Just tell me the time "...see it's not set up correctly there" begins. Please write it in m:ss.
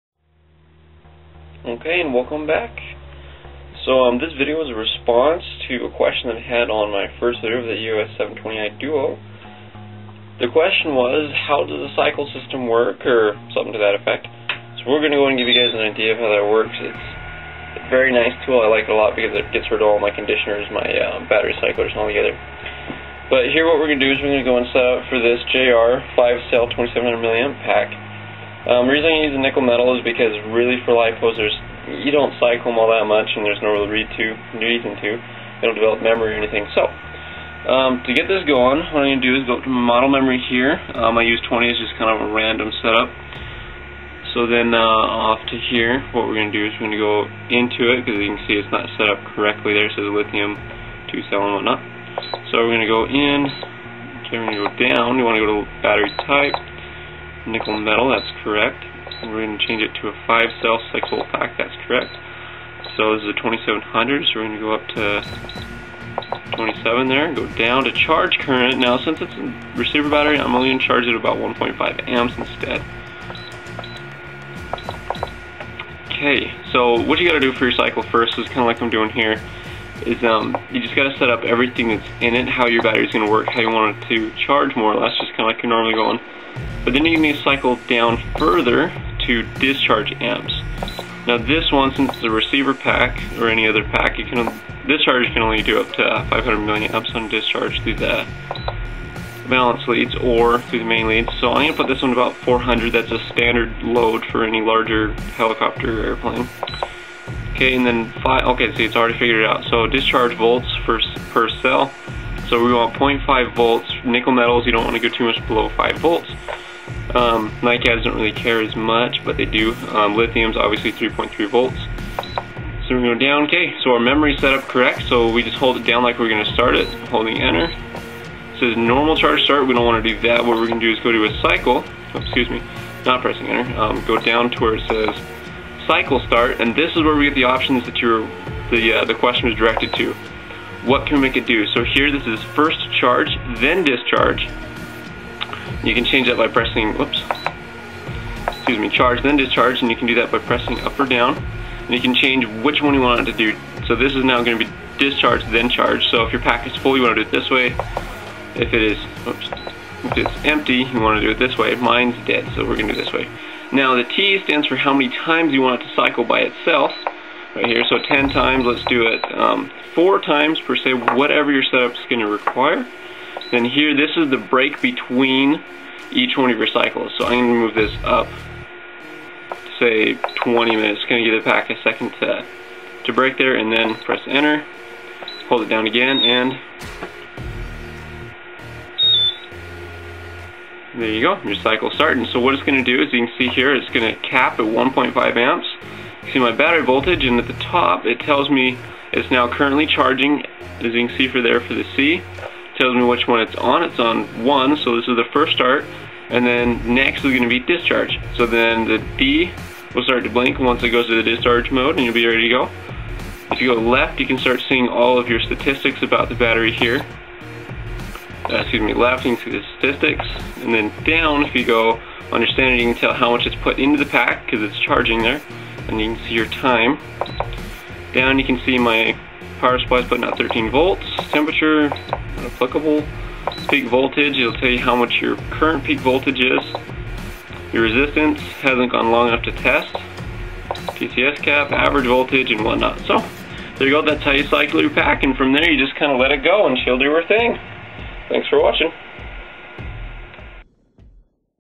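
0:48.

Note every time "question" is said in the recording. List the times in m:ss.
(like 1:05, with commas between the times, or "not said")
0:05, 0:10, 2:19.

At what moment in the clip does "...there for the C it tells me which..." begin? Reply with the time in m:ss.
3:21.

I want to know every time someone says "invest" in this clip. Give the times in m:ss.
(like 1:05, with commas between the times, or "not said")
not said.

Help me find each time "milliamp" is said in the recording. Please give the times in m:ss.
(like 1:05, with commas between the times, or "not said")
0:27, 1:36.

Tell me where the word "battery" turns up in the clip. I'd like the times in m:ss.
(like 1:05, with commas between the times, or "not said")
0:21, 0:55, 1:10, 1:22, 3:16, 3:36.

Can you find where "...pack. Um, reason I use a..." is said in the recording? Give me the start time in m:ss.
0:27.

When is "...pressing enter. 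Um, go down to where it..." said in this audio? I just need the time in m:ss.
2:13.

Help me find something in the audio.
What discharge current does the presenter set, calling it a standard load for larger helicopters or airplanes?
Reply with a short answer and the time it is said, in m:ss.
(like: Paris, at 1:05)
400, at 1:42.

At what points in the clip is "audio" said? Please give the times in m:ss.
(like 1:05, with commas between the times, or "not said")
not said.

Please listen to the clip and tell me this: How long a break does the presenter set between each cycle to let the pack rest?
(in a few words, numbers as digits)
20 minutes.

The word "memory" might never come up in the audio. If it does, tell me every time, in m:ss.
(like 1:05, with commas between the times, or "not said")
0:36, 0:40, 2:04.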